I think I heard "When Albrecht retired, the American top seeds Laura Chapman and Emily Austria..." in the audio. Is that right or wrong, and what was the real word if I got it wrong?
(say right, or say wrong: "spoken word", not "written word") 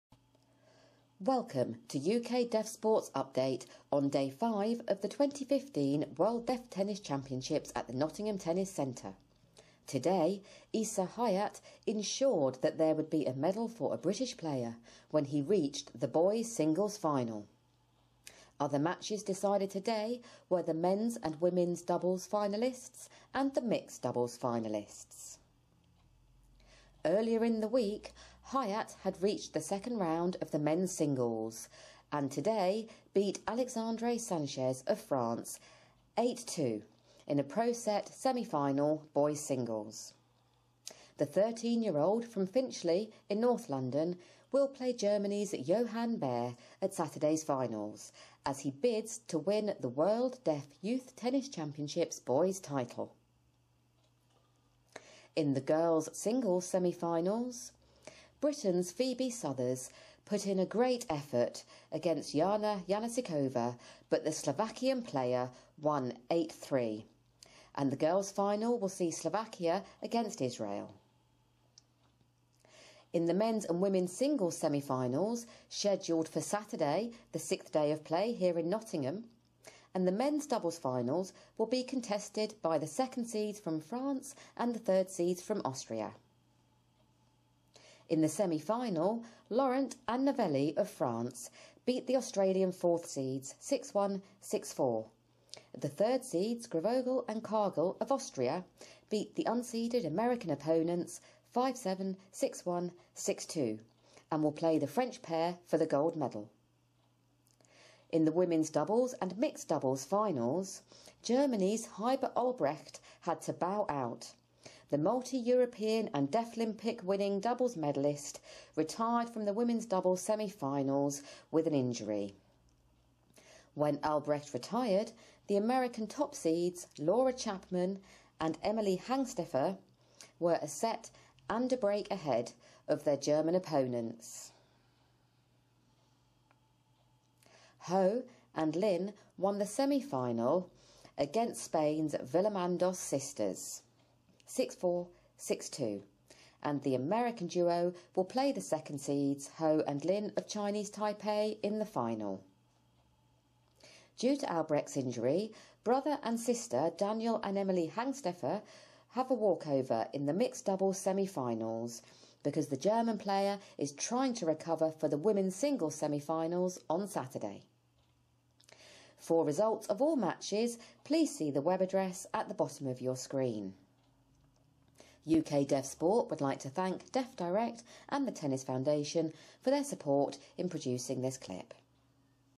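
wrong: "Hangsteffer", not "Austria".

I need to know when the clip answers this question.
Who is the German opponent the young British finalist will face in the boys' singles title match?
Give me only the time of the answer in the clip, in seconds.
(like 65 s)
45 s.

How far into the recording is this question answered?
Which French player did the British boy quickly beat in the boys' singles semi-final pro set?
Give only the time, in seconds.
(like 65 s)
33 s.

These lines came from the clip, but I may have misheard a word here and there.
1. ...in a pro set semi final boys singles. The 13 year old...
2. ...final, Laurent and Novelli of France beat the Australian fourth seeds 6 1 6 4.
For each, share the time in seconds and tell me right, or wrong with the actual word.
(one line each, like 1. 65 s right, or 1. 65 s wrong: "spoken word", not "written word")
1. 37 s right
2. 88 s right.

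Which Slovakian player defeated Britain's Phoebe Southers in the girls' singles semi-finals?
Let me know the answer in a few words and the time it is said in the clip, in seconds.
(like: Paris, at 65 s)
Jana Janasikova, at 62 s.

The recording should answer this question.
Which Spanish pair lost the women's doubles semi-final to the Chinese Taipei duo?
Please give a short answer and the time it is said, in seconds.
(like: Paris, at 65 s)
Villamandos sisters, at 142 s.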